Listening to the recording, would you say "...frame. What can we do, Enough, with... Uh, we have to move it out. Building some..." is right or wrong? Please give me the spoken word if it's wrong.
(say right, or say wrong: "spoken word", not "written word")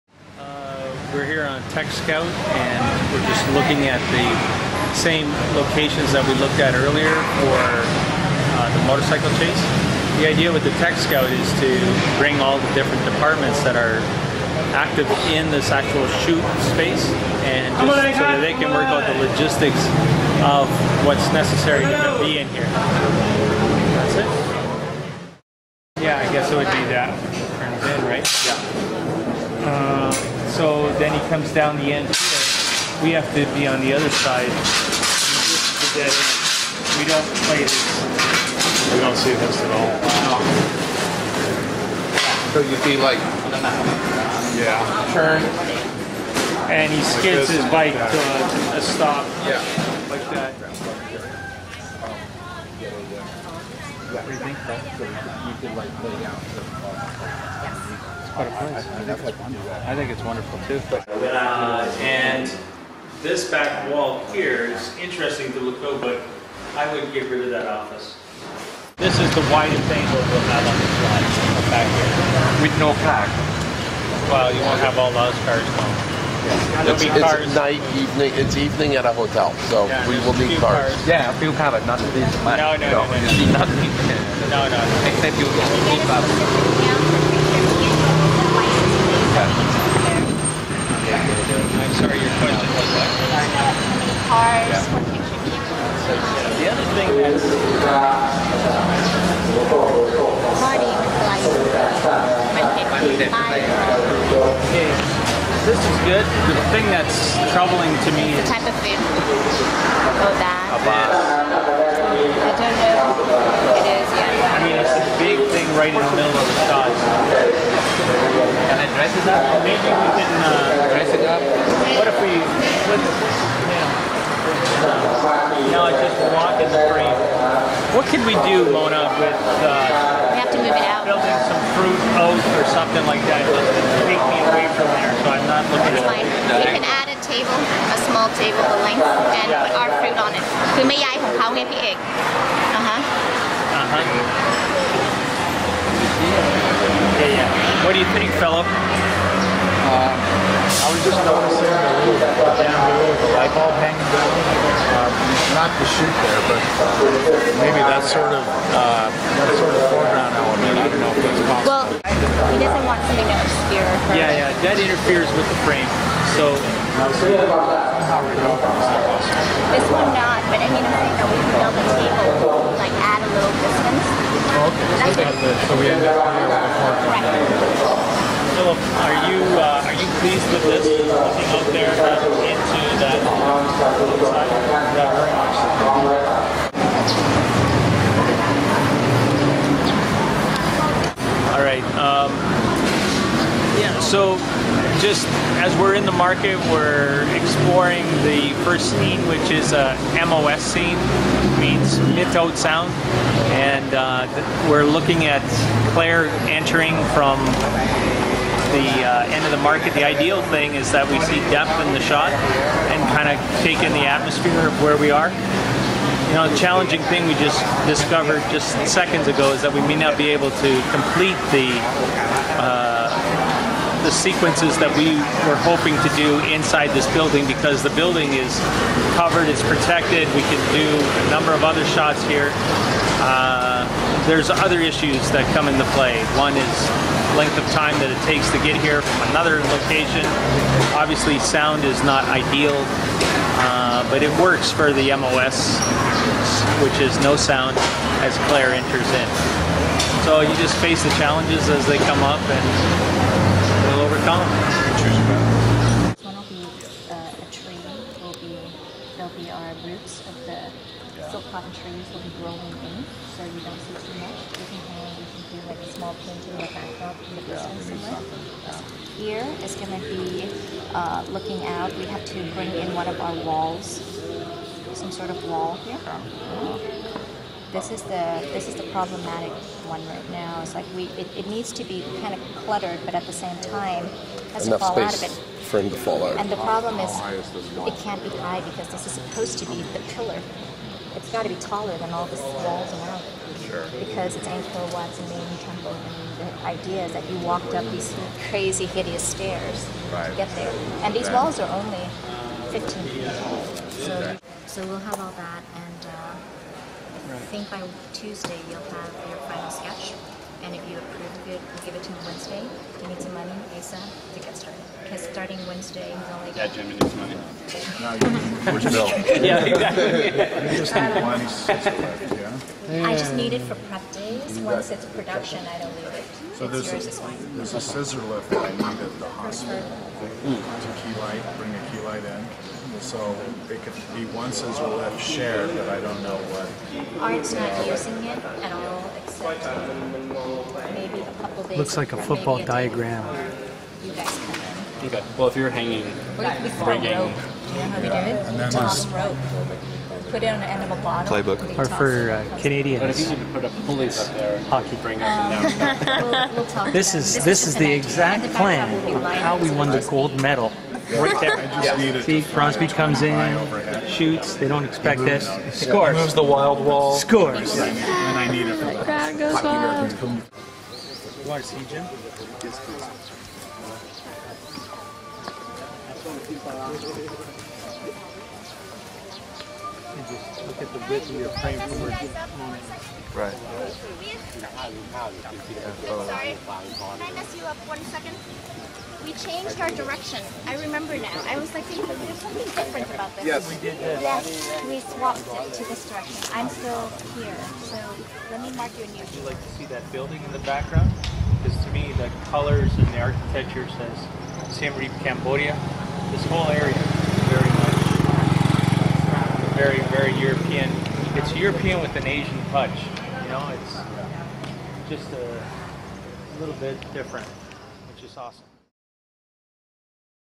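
wrong: "Mona", not "Enough".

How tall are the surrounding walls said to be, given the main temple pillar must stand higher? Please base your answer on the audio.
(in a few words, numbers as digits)
15 feet.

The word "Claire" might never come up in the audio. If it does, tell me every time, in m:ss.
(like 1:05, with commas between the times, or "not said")
3:25, 4:08.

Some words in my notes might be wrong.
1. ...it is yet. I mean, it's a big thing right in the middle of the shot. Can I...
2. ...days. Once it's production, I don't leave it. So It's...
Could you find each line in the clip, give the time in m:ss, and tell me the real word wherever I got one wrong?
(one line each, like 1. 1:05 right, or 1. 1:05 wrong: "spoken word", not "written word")
1. 1:53 right
2. 5:24 right.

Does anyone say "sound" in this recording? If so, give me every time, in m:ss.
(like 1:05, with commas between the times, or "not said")
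3:22, 4:01, 4:07.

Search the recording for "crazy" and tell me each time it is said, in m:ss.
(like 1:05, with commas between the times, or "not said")
4:58.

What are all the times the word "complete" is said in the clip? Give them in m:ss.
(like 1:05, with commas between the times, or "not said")
3:40.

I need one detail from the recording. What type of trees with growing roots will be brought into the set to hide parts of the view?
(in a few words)
silk cotton trees.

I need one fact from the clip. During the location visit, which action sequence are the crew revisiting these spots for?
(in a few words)
motorcycle chase.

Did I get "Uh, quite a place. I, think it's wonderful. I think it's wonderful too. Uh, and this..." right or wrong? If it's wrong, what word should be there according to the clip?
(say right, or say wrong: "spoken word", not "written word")
right.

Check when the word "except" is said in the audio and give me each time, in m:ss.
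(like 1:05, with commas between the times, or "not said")
1:25, 5:39.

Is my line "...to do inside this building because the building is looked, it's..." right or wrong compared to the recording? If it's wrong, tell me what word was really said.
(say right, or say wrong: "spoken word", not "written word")
wrong: "covered", not "looked".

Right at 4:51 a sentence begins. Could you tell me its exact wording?
It's got to be taller than all the walls around it.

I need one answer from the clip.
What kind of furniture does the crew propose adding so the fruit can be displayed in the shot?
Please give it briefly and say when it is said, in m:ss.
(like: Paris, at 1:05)
small table, at 2:17.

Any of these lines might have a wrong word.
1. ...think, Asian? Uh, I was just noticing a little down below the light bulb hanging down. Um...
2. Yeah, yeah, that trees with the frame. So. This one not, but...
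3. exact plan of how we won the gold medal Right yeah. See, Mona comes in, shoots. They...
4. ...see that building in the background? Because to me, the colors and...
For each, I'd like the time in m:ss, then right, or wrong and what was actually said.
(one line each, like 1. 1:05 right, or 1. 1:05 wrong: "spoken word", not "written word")
1. 2:28 wrong: "Philip", not "Asian"
2. 2:44 wrong: "interferes", not "trees"
3. 5:57 wrong: "Crosby", not "Mona"
4. 6:39 right.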